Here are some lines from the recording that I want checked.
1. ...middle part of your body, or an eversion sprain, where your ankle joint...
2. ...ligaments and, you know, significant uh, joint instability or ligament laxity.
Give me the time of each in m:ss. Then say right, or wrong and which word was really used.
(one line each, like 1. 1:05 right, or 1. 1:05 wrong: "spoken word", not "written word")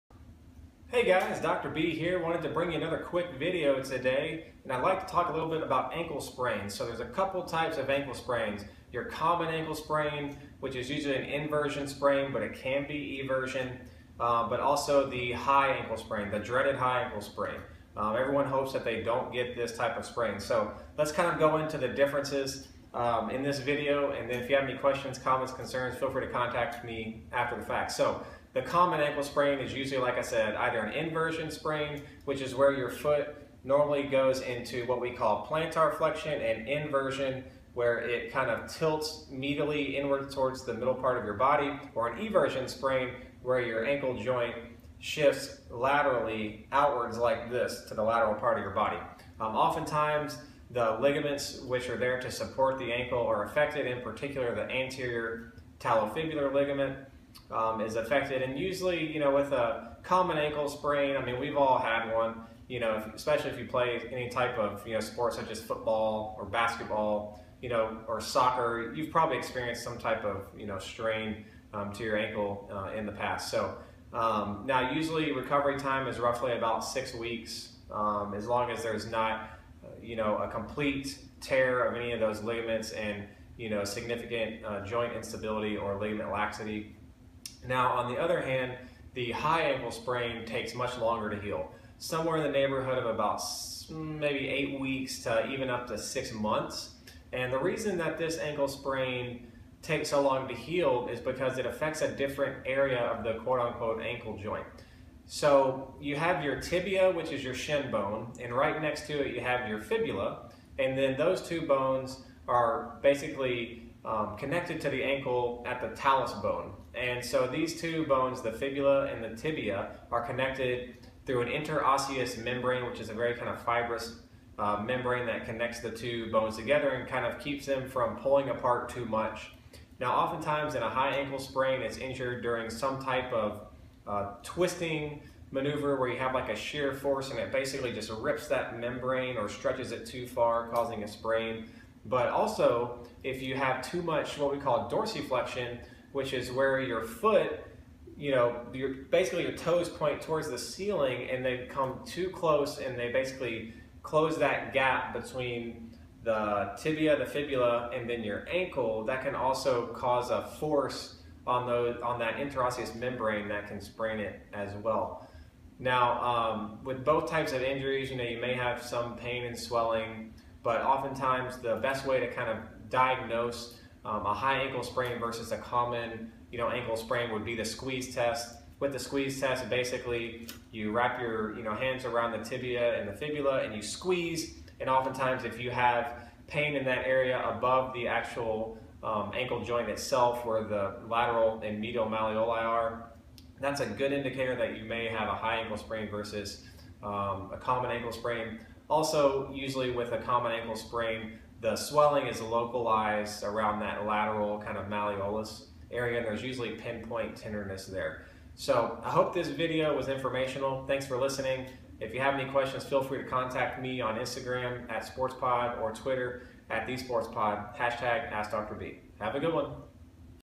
1. 0:40 right
2. 1:22 right.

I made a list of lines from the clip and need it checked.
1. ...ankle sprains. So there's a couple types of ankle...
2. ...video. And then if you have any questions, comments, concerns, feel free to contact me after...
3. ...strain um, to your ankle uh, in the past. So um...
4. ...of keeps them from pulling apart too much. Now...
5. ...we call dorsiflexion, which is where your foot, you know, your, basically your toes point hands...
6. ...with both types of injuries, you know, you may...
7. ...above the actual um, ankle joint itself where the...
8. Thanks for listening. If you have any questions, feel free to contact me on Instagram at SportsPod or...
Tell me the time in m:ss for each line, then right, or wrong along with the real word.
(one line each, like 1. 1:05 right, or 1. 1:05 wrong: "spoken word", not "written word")
1. 0:05 right
2. 0:23 right
3. 1:10 right
4. 2:07 right
5. 2:24 wrong: "towards", not "hands"
6. 2:46 right
7. 3:07 right
8. 3:30 right.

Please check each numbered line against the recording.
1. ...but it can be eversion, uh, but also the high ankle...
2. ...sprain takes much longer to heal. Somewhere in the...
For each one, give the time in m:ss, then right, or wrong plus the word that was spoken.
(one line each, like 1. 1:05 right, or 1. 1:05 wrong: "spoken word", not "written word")
1. 0:12 right
2. 1:29 right.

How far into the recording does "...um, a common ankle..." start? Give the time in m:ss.
3:17.